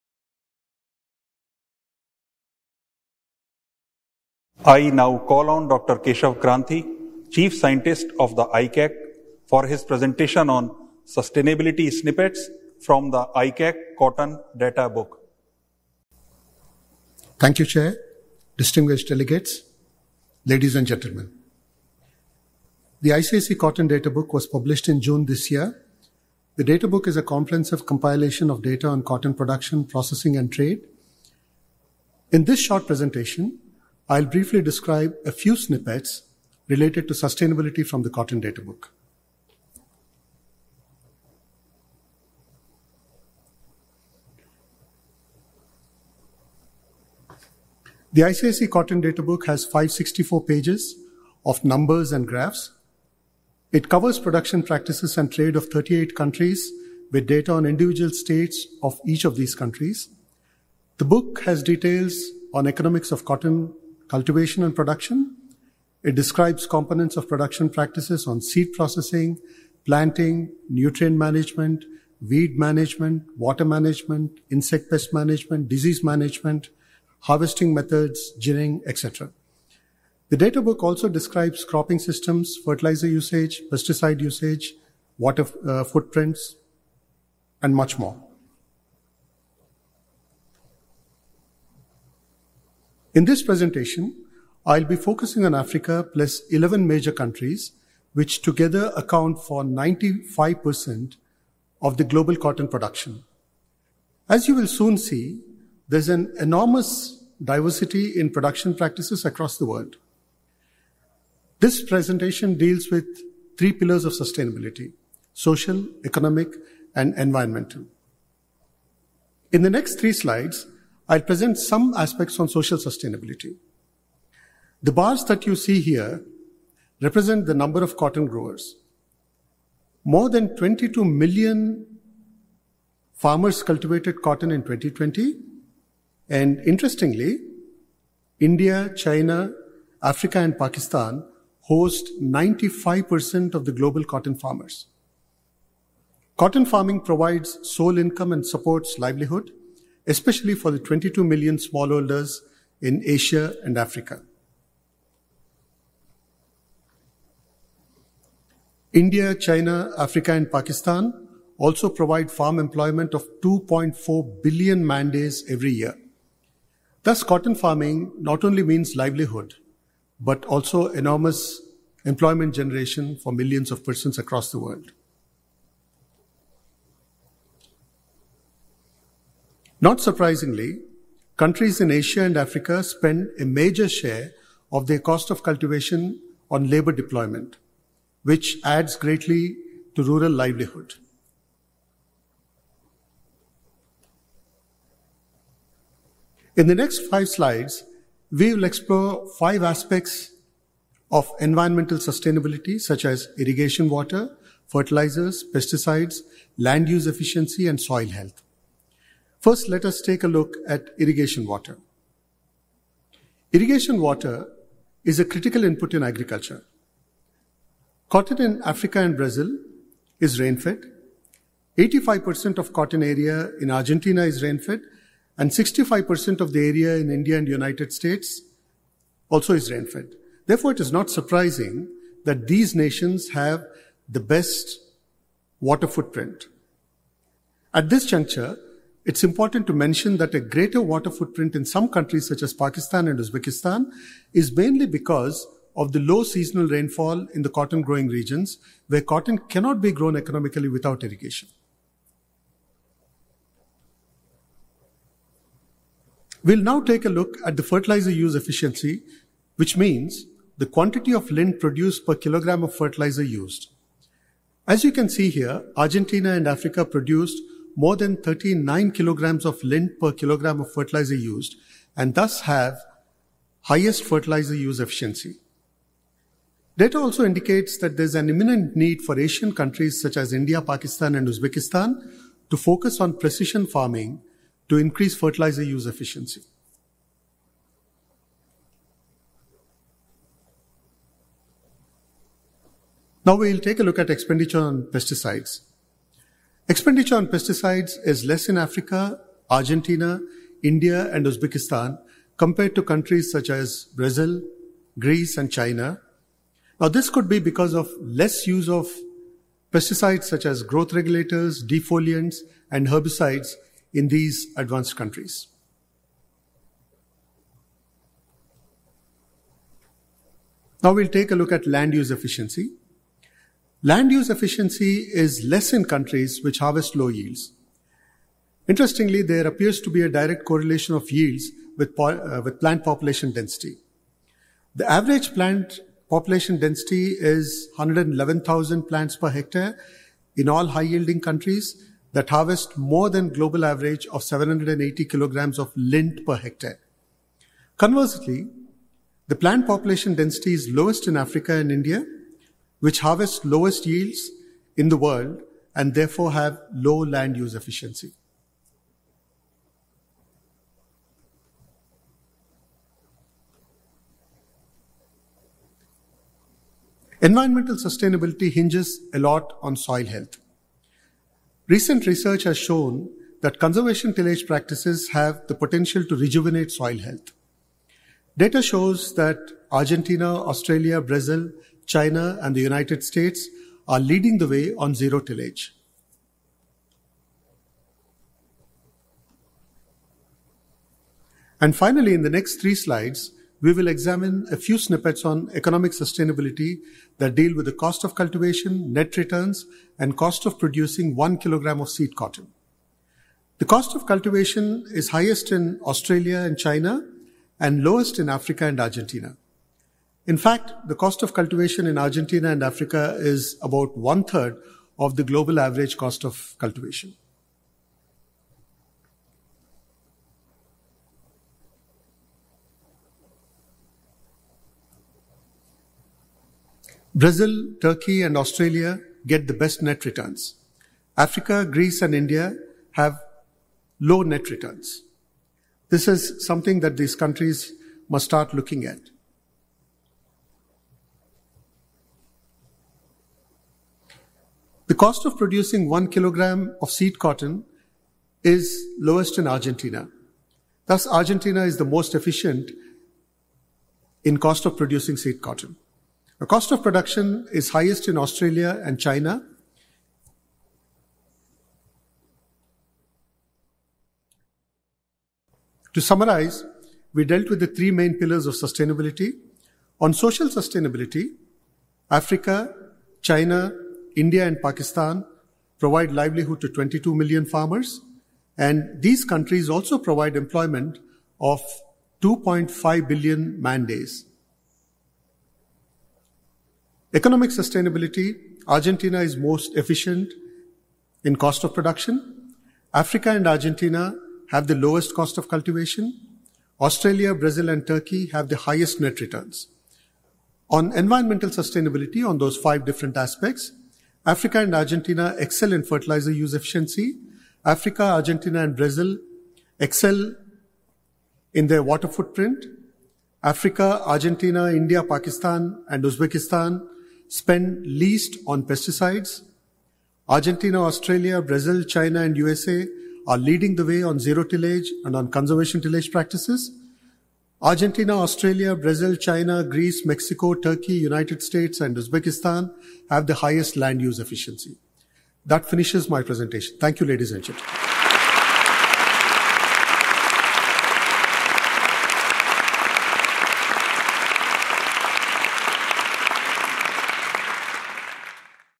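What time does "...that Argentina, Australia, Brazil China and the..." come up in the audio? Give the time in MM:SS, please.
06:19.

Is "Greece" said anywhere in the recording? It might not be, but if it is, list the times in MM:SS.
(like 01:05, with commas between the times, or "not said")
05:04, 07:11, 08:49.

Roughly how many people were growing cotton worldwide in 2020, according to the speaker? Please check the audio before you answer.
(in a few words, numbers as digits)
More than 22 million.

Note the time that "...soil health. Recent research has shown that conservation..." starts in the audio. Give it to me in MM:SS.
06:09.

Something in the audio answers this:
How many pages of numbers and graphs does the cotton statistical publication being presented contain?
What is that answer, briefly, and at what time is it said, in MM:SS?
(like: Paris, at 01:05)
564, at 00:49.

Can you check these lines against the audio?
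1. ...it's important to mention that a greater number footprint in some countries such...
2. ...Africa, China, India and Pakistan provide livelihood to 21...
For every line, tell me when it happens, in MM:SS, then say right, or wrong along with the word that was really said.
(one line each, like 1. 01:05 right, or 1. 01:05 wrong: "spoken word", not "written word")
1. 03:59 wrong: "water", not "number"
2. 07:52 wrong: "22", not "21".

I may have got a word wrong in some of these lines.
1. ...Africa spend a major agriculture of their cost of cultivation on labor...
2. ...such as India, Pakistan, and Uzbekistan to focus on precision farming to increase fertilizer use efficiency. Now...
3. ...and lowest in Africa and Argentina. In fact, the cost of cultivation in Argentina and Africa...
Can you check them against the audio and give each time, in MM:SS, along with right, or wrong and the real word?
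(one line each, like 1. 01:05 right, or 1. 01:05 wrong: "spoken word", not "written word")
1. 03:02 wrong: "share", not "agriculture"
2. 04:40 right
3. 06:47 right.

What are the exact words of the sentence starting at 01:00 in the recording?
The book has details on economics of cotton cultivation and production.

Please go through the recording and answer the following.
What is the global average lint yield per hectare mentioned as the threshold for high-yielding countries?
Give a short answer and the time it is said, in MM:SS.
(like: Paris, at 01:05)
780 kilograms, at 05:44.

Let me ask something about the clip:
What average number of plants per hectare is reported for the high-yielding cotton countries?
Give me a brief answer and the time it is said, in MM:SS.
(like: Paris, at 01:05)
111,000, at 05:37.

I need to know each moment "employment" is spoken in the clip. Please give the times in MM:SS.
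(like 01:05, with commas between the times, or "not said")
02:42, 02:52, 08:00.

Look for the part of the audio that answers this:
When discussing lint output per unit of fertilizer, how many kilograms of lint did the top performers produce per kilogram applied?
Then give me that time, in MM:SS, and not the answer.
04:27.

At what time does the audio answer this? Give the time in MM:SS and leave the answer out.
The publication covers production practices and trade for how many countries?
00:55.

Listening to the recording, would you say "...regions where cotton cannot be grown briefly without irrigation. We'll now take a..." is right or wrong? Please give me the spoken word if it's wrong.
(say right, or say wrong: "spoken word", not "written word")
wrong: "economically", not "briefly".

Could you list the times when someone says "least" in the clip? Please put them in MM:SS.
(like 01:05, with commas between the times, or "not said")
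08:37.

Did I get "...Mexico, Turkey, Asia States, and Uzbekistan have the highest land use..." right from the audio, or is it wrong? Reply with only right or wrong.
wrong.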